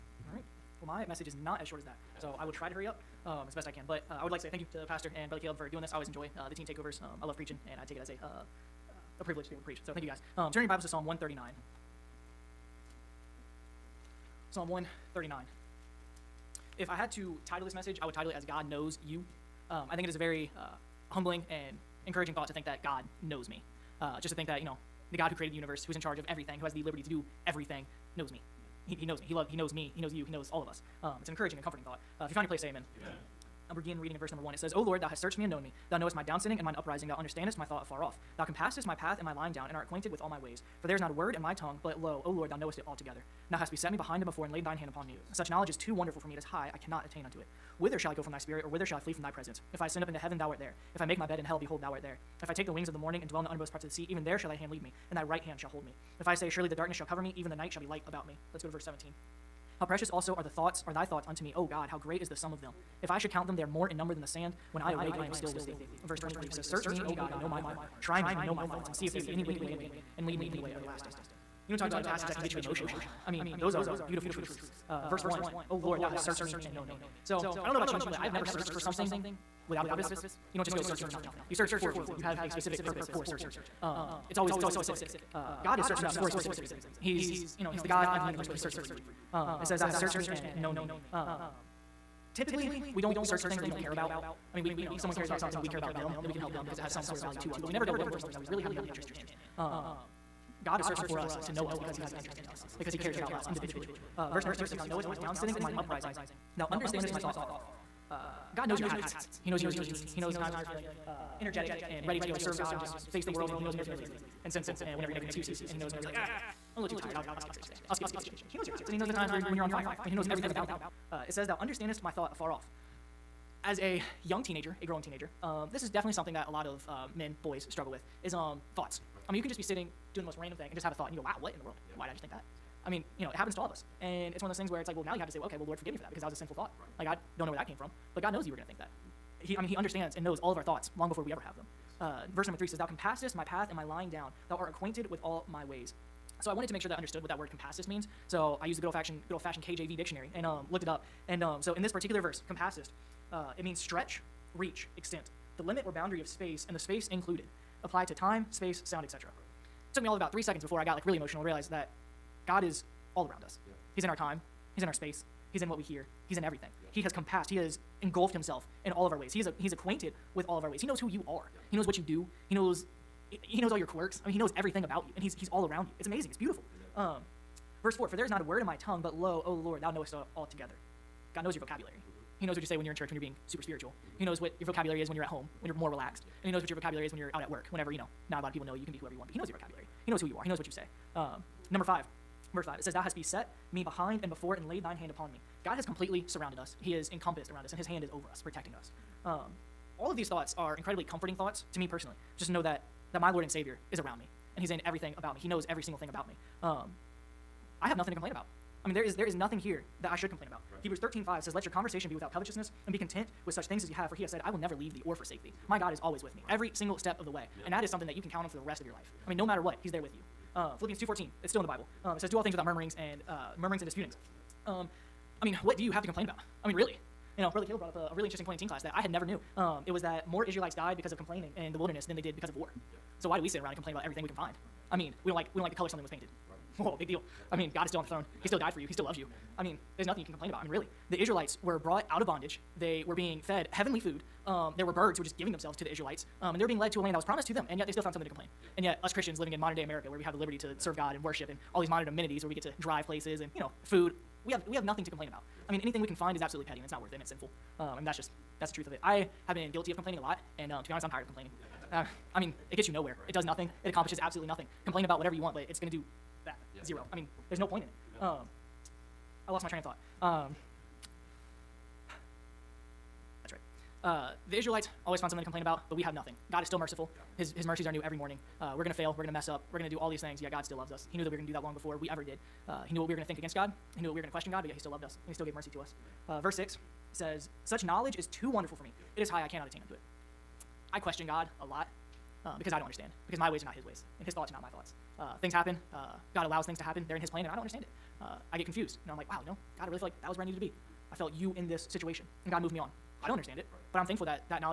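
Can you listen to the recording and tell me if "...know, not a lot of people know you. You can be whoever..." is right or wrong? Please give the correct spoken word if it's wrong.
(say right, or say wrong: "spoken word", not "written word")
right.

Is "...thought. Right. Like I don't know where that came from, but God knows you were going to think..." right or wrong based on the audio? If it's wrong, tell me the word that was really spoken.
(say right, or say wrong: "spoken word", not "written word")
right.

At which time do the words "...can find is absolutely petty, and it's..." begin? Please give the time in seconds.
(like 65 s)
256 s.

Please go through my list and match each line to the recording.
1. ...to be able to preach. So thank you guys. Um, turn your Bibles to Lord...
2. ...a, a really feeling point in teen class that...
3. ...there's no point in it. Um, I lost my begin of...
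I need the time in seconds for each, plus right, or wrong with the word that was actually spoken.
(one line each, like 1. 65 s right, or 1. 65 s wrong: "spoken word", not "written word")
1. 9 s wrong: "Psalm", not "Lord"
2. 227 s wrong: "interesting", not "feeling"
3. 267 s wrong: "train", not "begin".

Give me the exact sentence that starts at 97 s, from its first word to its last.
But we never go looking for something that we really have no interest in.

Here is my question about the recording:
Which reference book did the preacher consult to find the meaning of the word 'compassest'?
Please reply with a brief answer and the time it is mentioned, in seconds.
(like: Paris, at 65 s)
KJV dictionary, at 149 s.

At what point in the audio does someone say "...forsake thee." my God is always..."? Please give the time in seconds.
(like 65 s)
215 s.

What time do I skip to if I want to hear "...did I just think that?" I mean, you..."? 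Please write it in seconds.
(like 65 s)
132 s.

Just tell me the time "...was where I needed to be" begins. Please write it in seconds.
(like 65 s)
300 s.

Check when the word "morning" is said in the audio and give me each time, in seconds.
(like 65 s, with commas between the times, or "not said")
52 s, 278 s.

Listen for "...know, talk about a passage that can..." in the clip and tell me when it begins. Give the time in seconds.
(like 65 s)
71 s.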